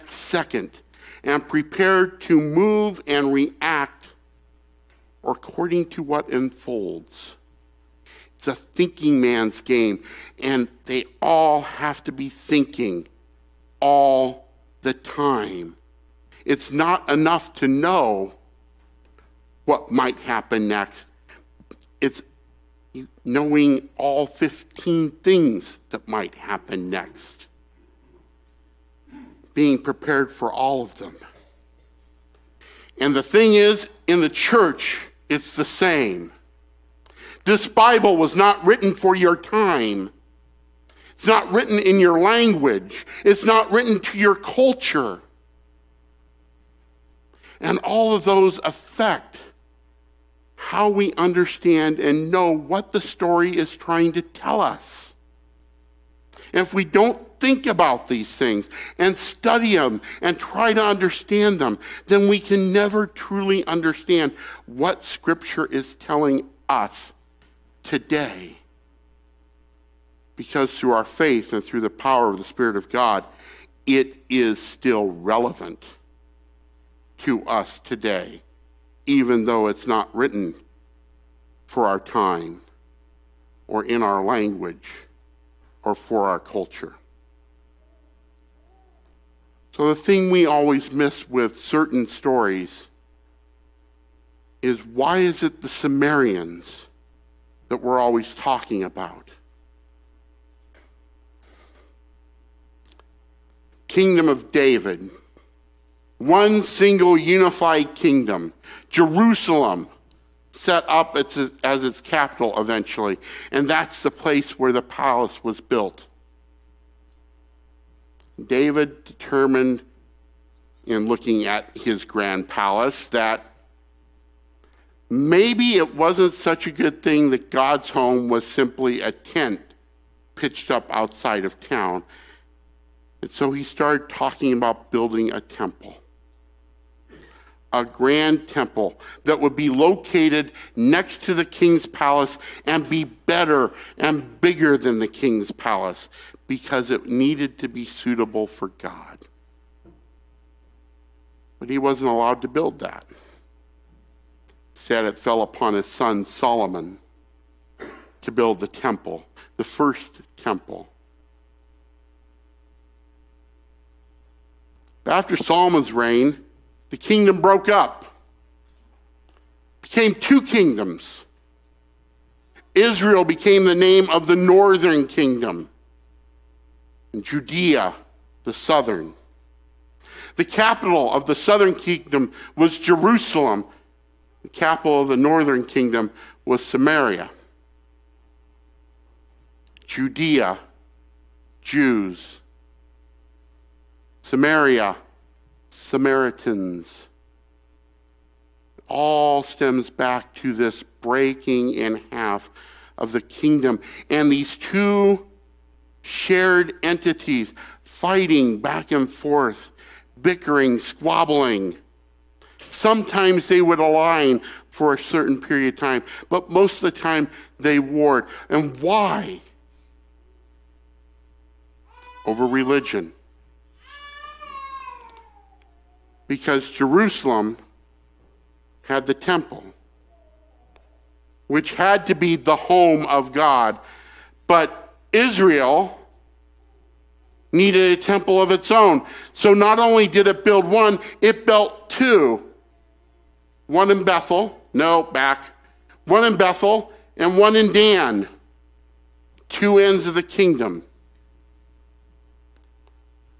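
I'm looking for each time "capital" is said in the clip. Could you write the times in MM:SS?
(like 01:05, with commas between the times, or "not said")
01:52, 03:00, 03:04.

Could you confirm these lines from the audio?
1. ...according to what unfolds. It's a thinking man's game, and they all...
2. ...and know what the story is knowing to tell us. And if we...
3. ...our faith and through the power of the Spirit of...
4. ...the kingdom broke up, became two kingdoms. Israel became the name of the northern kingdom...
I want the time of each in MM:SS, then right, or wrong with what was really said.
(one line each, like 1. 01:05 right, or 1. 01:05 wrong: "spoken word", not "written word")
1. 00:05 right
2. 00:51 wrong: "trying", not "knowing"
3. 01:10 right
4. 02:46 right.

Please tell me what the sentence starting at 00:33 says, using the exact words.
And the thing is, in the church, it's the same.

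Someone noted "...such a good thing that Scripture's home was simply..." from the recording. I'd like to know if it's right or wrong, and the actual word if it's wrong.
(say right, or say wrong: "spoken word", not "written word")
wrong: "God", not "Scripture".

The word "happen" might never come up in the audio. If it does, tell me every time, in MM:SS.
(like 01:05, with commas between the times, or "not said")
00:20, 00:26.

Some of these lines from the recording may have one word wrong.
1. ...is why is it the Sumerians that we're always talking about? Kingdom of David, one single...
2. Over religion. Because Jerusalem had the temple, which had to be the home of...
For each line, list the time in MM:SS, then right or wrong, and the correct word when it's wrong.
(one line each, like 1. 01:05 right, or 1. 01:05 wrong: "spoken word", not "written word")
1. 01:34 right
2. 03:42 right.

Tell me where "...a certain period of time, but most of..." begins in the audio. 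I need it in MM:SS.
03:34.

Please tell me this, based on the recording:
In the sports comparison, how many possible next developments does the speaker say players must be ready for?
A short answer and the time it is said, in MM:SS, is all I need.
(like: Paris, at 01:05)
15, at 00:24.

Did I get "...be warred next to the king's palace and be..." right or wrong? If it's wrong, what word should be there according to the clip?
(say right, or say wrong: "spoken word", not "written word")
wrong: "located", not "warred".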